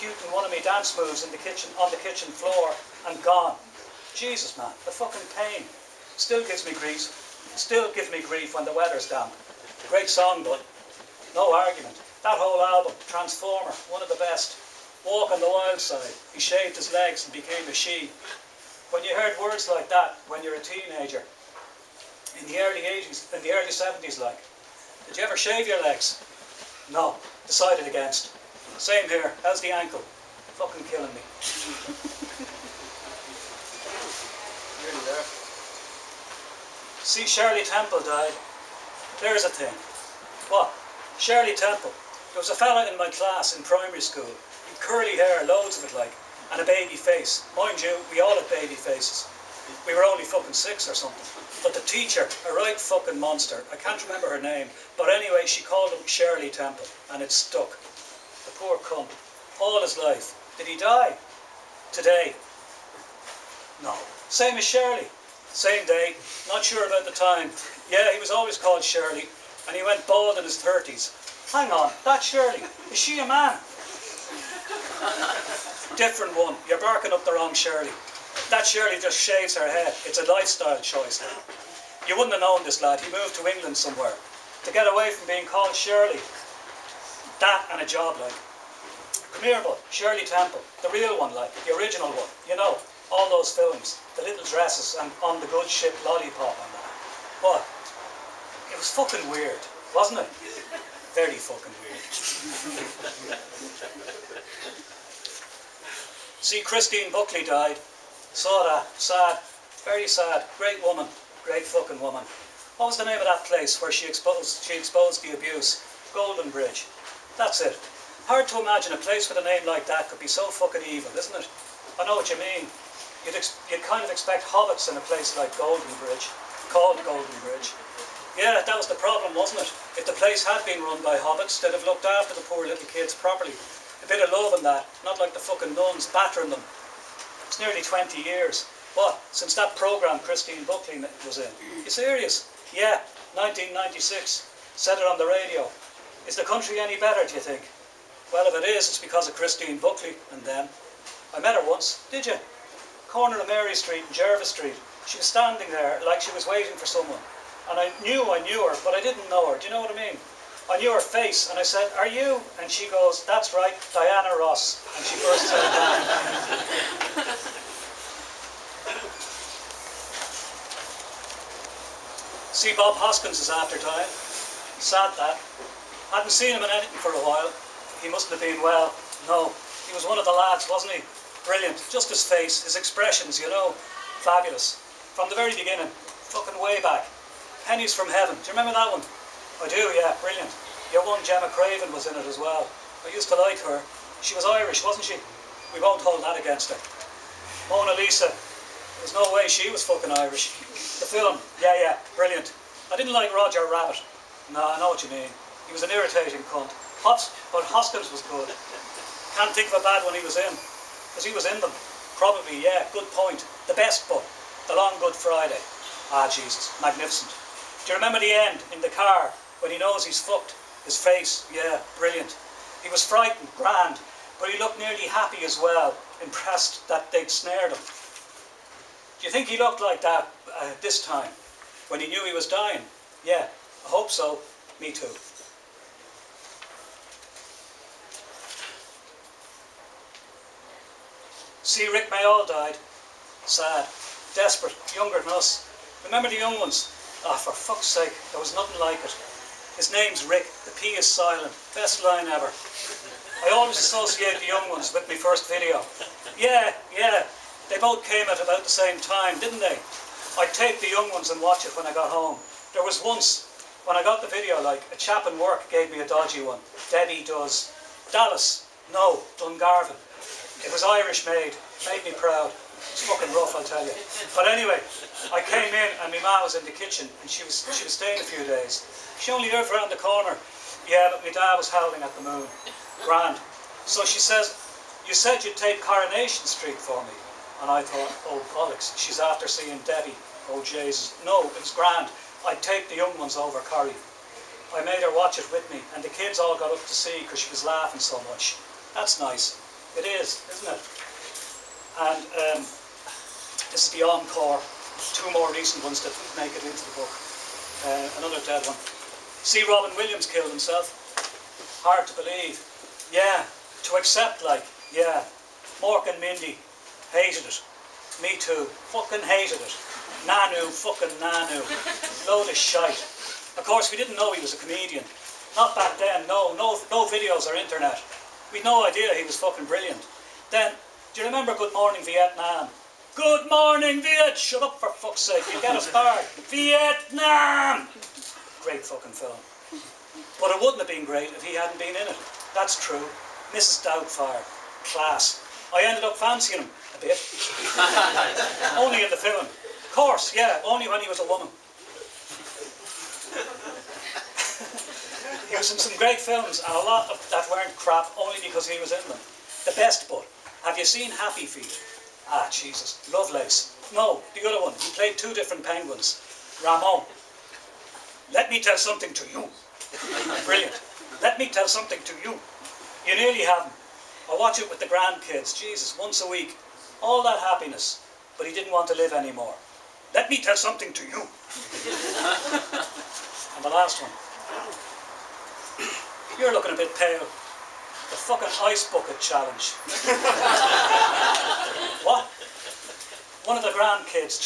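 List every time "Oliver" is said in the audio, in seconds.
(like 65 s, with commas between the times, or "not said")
not said.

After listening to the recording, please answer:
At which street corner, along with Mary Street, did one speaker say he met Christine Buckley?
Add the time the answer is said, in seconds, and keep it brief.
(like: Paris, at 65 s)
Jervis Street, at 154 s.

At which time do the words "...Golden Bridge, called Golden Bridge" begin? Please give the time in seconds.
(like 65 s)
125 s.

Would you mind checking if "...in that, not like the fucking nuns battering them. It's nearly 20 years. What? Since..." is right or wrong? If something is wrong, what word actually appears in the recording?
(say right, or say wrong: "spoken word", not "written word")
right.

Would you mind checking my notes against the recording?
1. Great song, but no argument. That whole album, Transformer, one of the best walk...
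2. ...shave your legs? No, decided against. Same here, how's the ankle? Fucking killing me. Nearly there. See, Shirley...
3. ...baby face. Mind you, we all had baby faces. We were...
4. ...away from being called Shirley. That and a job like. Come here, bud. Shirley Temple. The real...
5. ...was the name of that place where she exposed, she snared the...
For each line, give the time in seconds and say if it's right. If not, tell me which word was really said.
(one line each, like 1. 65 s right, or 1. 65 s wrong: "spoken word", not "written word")
1. 9 s right
2. 25 s right
3. 46 s right
4. 84 s right
5. 112 s wrong: "exposed", not "snared".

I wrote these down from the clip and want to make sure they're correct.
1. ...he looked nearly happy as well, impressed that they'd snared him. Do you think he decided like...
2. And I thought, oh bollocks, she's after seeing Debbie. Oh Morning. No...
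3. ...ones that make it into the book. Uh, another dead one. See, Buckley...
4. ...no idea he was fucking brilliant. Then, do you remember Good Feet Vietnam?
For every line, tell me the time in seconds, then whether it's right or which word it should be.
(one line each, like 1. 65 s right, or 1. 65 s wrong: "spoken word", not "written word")
1. 224 s wrong: "looked", not "decided"
2. 287 s wrong: "Jesus", not "Morning"
3. 305 s wrong: "Robin", not "Buckley"
4. 328 s wrong: "Morning", not "Feet".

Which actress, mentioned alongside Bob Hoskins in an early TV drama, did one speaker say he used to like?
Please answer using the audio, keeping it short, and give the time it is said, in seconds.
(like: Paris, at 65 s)
Gemma Craven, at 191 s.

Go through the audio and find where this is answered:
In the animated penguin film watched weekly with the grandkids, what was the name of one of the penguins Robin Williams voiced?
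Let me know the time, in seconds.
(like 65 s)
366 s.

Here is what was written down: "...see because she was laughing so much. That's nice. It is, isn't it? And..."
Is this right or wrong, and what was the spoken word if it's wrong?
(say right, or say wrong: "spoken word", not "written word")
right.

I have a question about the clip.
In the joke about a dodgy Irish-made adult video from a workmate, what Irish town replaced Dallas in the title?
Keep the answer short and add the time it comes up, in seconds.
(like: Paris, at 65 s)
Dungarvan, at 269 s.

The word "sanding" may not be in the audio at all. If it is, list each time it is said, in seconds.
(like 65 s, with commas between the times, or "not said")
not said.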